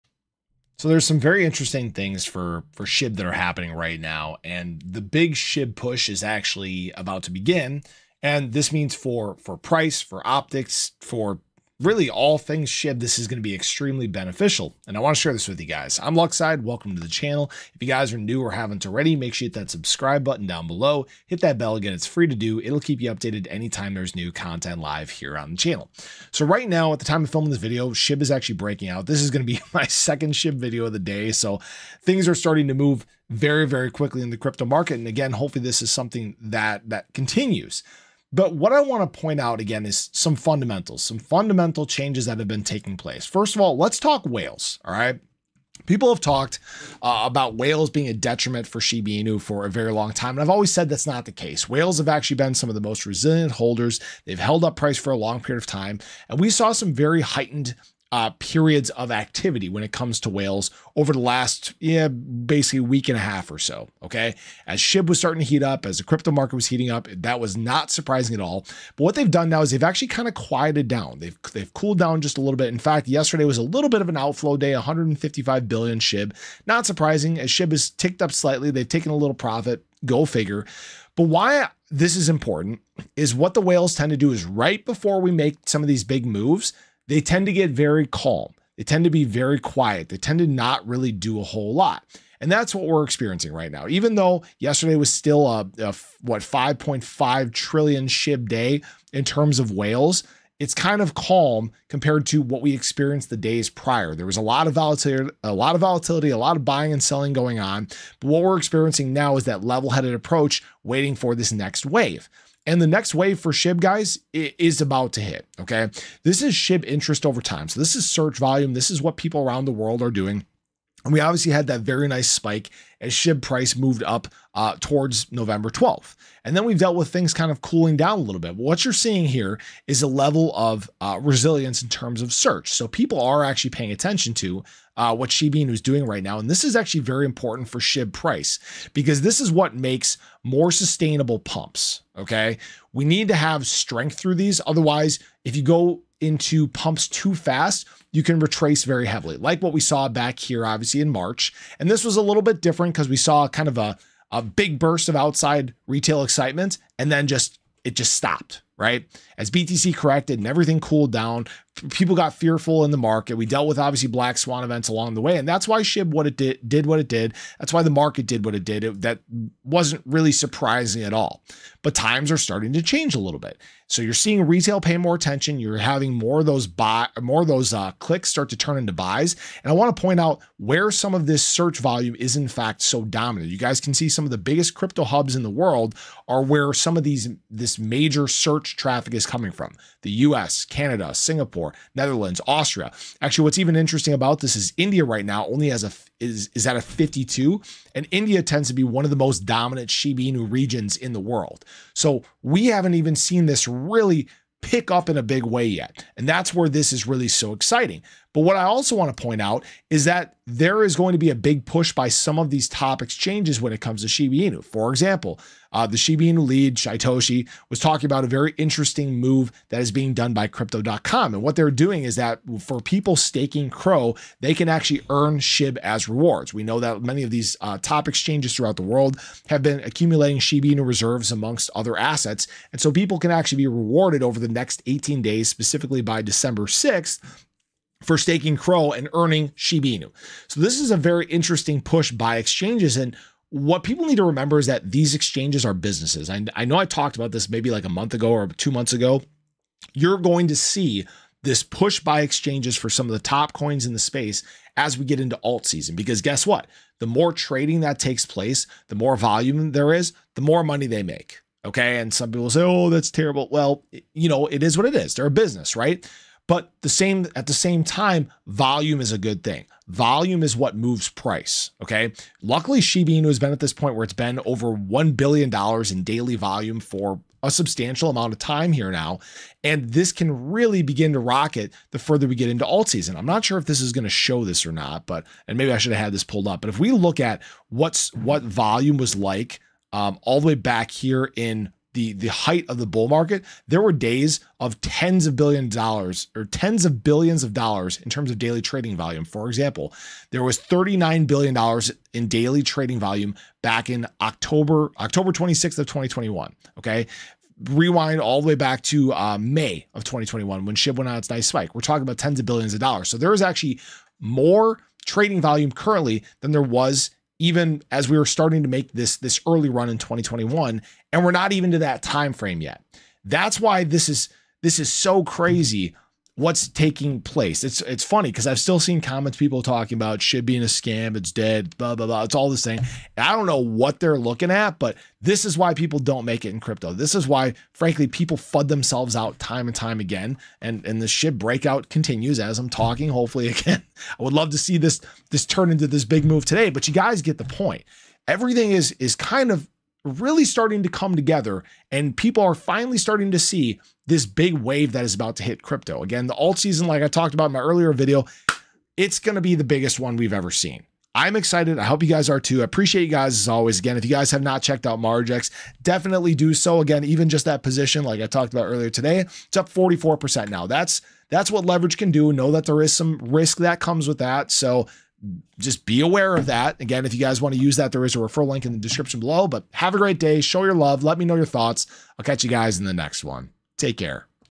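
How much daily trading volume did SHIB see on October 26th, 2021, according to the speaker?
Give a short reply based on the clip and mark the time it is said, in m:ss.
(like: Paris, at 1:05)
$39 billion, at 5:00.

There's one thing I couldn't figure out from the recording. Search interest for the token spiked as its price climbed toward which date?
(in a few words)
November 12th.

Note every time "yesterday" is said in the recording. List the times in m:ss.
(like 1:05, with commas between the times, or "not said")
1:13, 1:34.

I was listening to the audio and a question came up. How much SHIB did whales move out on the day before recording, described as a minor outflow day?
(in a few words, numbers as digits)
155 billion.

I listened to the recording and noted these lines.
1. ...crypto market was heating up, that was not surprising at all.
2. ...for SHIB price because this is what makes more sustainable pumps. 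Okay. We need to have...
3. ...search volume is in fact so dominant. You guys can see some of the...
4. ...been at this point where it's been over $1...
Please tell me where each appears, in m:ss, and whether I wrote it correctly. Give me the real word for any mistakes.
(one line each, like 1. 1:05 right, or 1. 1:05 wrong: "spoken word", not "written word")
1. 1:06 right
2. 2:17 right
3. 3:01 right
4. 4:33 right.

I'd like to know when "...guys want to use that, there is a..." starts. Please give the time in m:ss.
6:17.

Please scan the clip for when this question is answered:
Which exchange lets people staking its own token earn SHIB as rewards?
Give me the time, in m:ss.
3:40.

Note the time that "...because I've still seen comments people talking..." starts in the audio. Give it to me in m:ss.
5:28.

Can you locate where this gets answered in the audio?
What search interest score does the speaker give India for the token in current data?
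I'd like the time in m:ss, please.
3:16.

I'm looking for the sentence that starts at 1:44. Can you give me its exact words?
There was a lot of volatility, a lot of volatility, a lot of buying and selling going on.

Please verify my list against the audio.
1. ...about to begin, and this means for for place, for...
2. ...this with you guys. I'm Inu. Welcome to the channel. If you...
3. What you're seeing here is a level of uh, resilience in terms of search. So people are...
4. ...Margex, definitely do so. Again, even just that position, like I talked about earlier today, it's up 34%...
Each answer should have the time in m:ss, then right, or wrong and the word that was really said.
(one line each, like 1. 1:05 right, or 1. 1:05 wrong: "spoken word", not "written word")
1. 0:06 wrong: "price", not "place"
2. 0:15 wrong: "Luckside", not "Inu"
3. 2:08 right
4. 6:04 wrong: "44", not "34".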